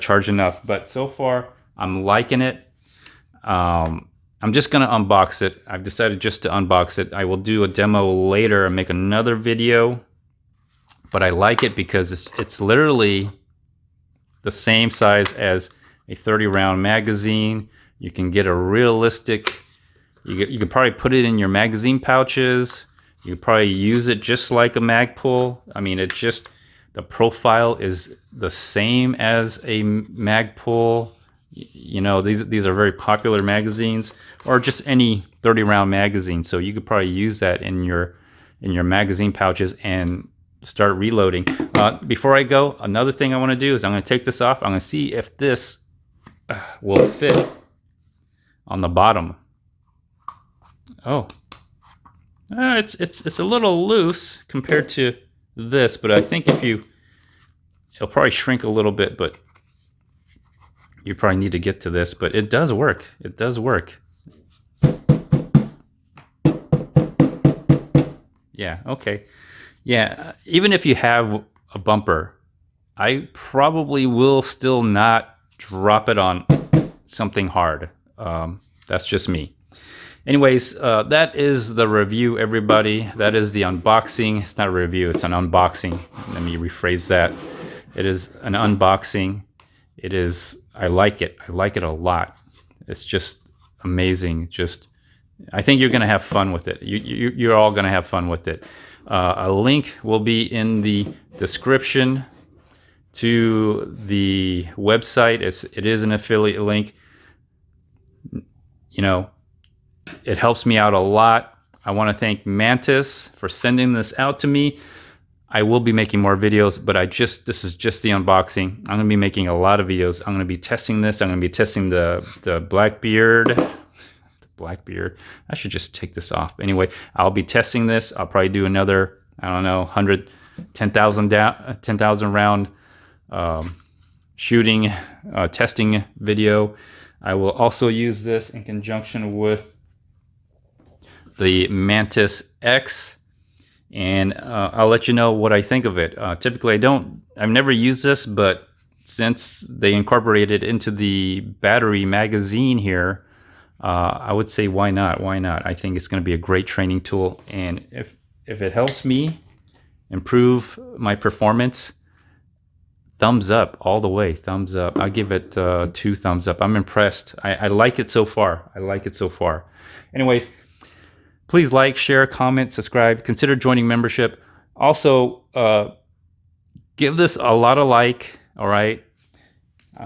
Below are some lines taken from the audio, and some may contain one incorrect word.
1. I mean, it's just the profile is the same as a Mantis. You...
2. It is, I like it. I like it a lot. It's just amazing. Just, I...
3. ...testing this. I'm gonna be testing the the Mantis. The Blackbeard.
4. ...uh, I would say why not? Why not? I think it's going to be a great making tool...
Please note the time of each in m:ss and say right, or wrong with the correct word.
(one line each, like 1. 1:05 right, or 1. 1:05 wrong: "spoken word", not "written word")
1. 0:25 wrong: "Magpul", not "Mantis"
2. 1:29 right
3. 2:00 wrong: "Blackbeard", not "Mantis"
4. 2:33 wrong: "training", not "making".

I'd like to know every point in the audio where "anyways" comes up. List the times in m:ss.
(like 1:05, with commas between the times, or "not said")
1:20, 2:06, 2:50.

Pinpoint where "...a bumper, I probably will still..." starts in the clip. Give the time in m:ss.
1:11.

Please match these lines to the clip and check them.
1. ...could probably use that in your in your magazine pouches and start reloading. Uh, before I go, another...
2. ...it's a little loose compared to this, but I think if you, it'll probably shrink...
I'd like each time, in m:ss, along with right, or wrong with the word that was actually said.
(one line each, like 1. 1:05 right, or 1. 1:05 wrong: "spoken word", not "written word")
1. 0:36 right
2. 0:53 right.